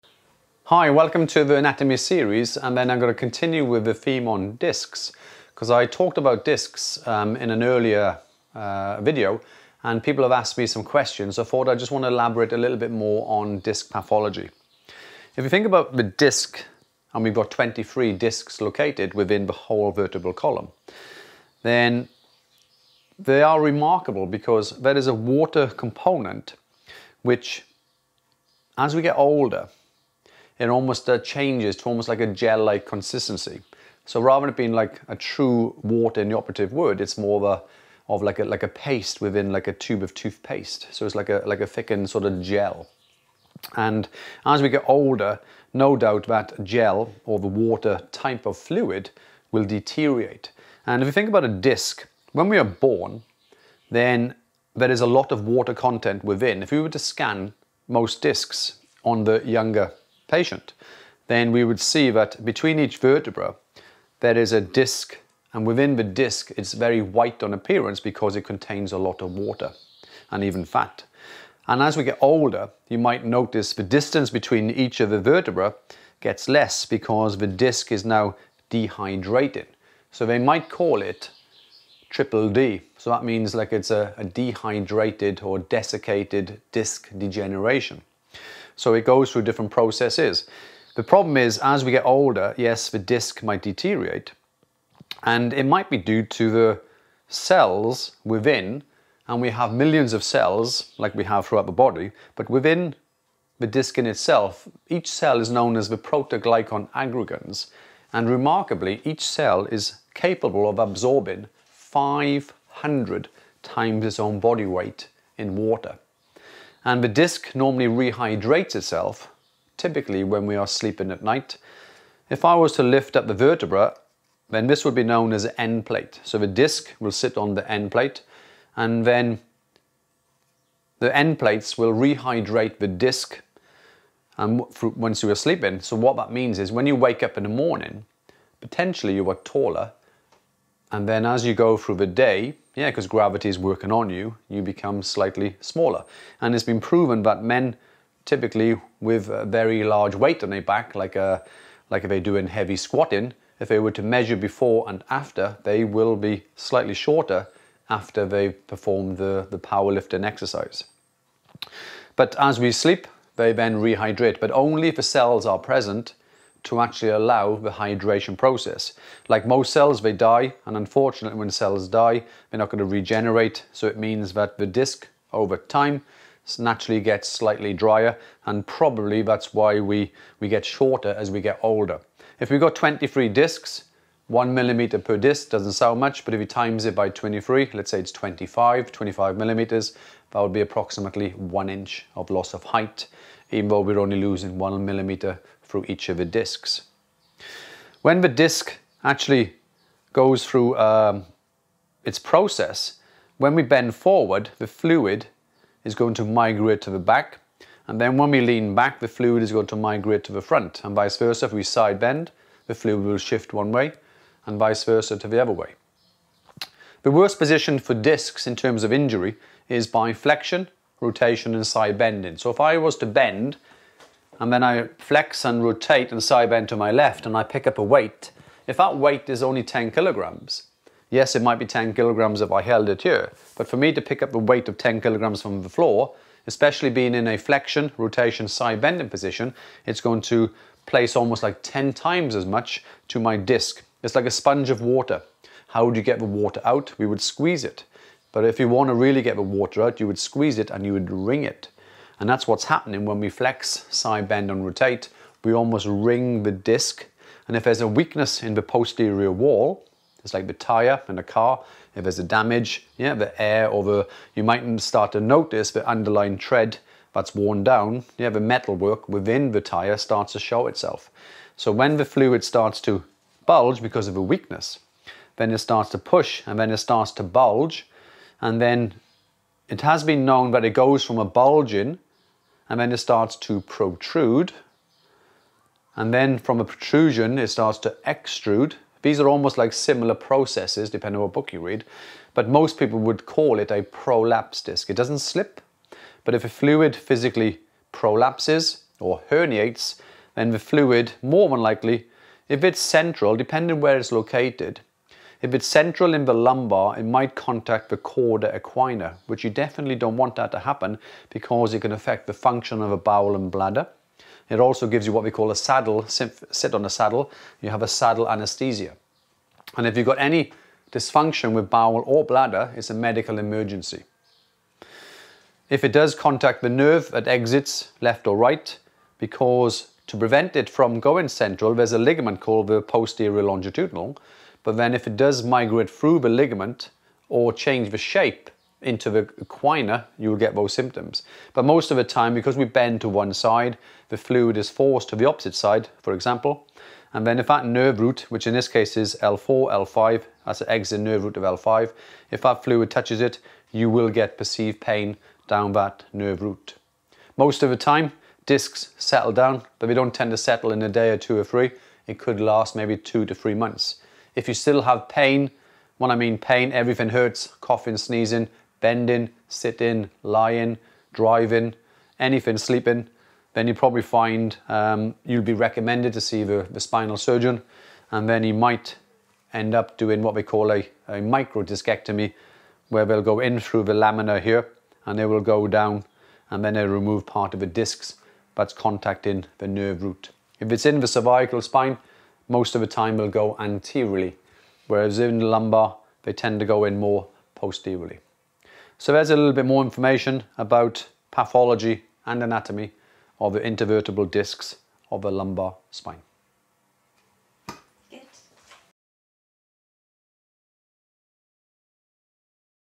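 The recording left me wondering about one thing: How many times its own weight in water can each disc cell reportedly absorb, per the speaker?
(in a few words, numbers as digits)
500 times.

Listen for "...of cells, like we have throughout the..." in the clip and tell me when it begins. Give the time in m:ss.
1:40.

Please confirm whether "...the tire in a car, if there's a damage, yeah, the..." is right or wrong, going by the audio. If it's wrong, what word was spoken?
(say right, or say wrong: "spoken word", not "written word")
right.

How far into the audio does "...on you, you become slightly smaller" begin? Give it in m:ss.
2:23.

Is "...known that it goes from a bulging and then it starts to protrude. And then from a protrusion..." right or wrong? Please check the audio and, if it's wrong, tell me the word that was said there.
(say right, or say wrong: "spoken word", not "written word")
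right.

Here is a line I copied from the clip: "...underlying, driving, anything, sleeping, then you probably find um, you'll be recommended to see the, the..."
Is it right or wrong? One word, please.
wrong.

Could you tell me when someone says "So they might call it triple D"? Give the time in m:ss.
1:20.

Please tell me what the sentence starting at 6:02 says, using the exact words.
It could last maybe two to three months.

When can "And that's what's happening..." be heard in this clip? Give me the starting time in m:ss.
4:12.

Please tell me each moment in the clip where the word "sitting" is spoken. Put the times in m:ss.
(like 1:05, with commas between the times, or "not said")
6:09.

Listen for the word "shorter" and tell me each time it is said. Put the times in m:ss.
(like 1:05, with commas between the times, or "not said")
2:36, 3:00.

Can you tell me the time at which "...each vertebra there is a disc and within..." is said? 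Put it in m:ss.
1:02.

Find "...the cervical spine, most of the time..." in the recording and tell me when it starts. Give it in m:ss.
6:31.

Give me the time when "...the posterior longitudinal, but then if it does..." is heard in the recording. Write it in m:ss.
5:32.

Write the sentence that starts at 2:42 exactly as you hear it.
But as we sleep, they then rehydrate, but only if the cells are present to actually allow the hydration process.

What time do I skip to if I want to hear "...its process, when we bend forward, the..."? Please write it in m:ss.
3:22.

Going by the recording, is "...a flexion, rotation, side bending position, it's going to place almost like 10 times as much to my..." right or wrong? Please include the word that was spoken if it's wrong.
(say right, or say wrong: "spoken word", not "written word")
right.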